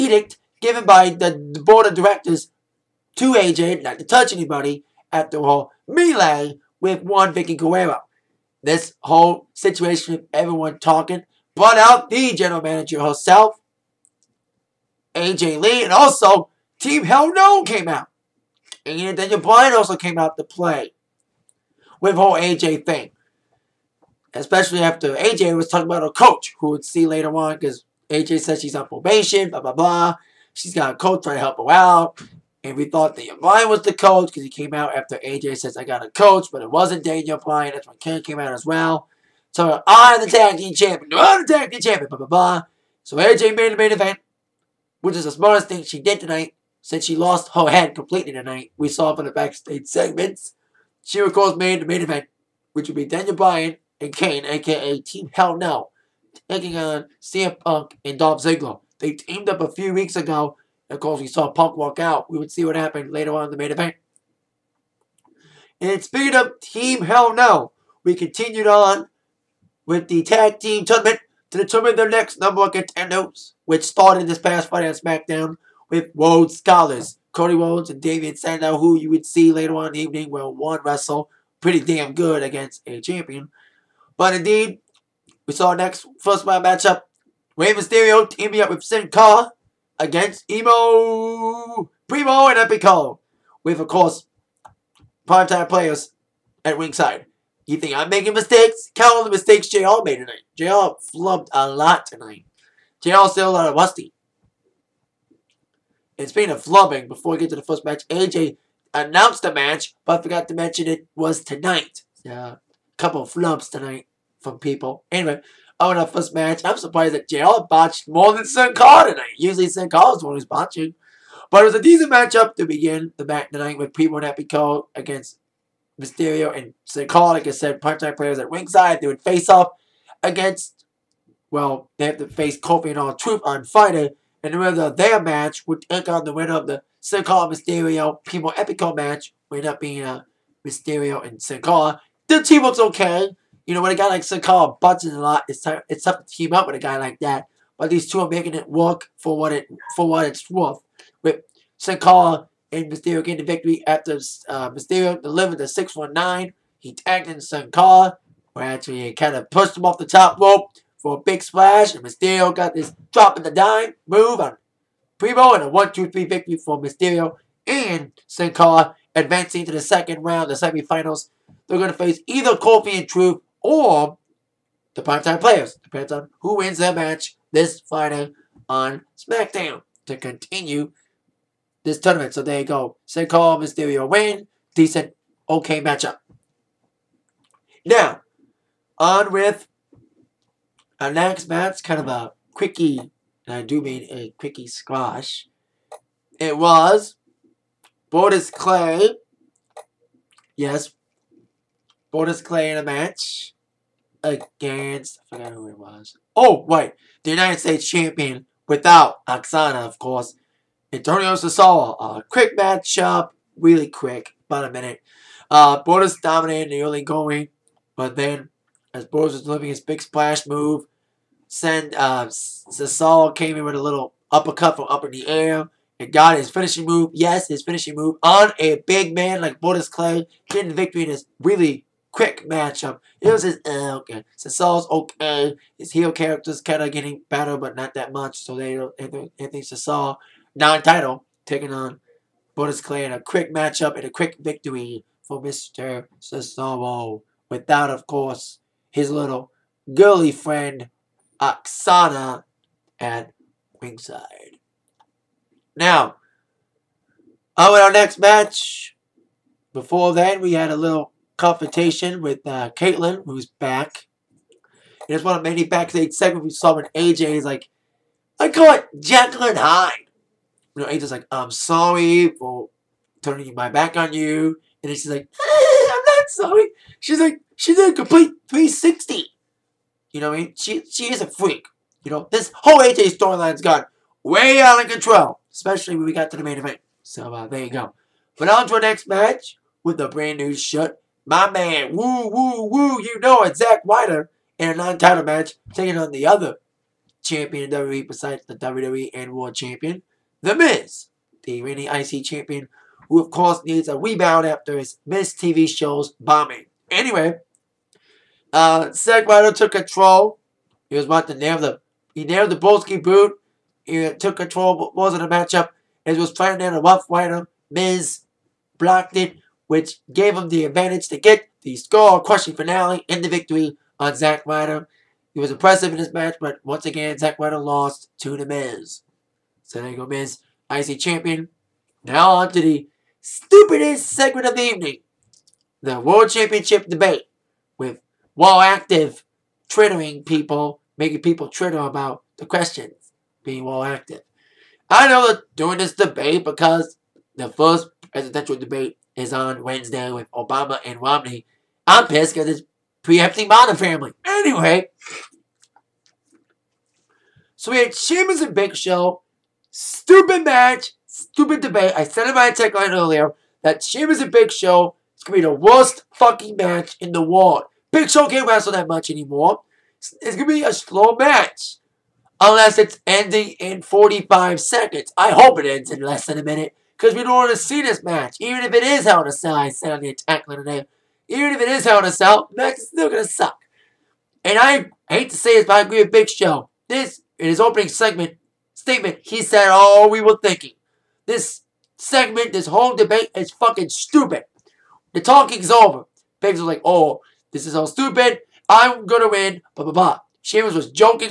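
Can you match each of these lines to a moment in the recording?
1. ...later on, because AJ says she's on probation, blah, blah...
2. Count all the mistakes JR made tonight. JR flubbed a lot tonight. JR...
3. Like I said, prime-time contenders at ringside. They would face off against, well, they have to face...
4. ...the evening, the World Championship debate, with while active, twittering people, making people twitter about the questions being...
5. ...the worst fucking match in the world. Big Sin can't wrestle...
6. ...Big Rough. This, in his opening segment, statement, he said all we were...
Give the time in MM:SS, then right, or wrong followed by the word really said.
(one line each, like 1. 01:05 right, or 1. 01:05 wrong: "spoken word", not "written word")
1. 00:27 right
2. 01:38 right
3. 02:07 wrong: "players", not "contenders"
4. 05:34 right
5. 06:05 wrong: "Show", not "Sin"
6. 06:26 wrong: "Show", not "Rough".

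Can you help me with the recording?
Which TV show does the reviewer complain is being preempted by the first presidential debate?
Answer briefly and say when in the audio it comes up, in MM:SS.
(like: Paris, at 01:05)
Modern Family, at 05:53.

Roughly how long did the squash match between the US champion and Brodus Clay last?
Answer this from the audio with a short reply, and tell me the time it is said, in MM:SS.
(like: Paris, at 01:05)
about a minute, at 03:34.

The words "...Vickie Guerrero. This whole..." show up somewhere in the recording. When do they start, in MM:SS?
00:07.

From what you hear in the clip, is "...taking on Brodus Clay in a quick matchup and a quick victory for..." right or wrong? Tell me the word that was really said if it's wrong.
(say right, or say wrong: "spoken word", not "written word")
right.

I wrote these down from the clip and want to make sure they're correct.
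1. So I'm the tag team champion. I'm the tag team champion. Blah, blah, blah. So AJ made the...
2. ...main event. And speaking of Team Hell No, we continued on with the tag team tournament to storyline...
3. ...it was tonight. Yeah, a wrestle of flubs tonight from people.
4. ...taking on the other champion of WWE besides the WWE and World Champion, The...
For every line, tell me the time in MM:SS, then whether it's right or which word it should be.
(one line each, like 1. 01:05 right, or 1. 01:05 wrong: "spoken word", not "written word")
1. 00:39 right
2. 01:03 wrong: "determine", not "storyline"
3. 01:50 wrong: "couple", not "wrestle"
4. 04:55 right.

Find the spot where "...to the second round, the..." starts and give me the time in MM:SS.
02:49.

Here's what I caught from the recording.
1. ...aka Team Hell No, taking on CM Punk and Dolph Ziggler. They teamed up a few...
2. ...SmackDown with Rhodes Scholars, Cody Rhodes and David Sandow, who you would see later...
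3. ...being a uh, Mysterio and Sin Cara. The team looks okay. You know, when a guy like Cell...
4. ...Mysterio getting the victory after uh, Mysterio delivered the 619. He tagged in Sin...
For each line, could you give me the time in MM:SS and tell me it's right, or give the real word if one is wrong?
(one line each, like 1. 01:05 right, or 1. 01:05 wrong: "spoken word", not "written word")
1. 00:54 right
2. 01:14 right
3. 02:19 wrong: "Sin", not "Cell"
4. 02:32 right.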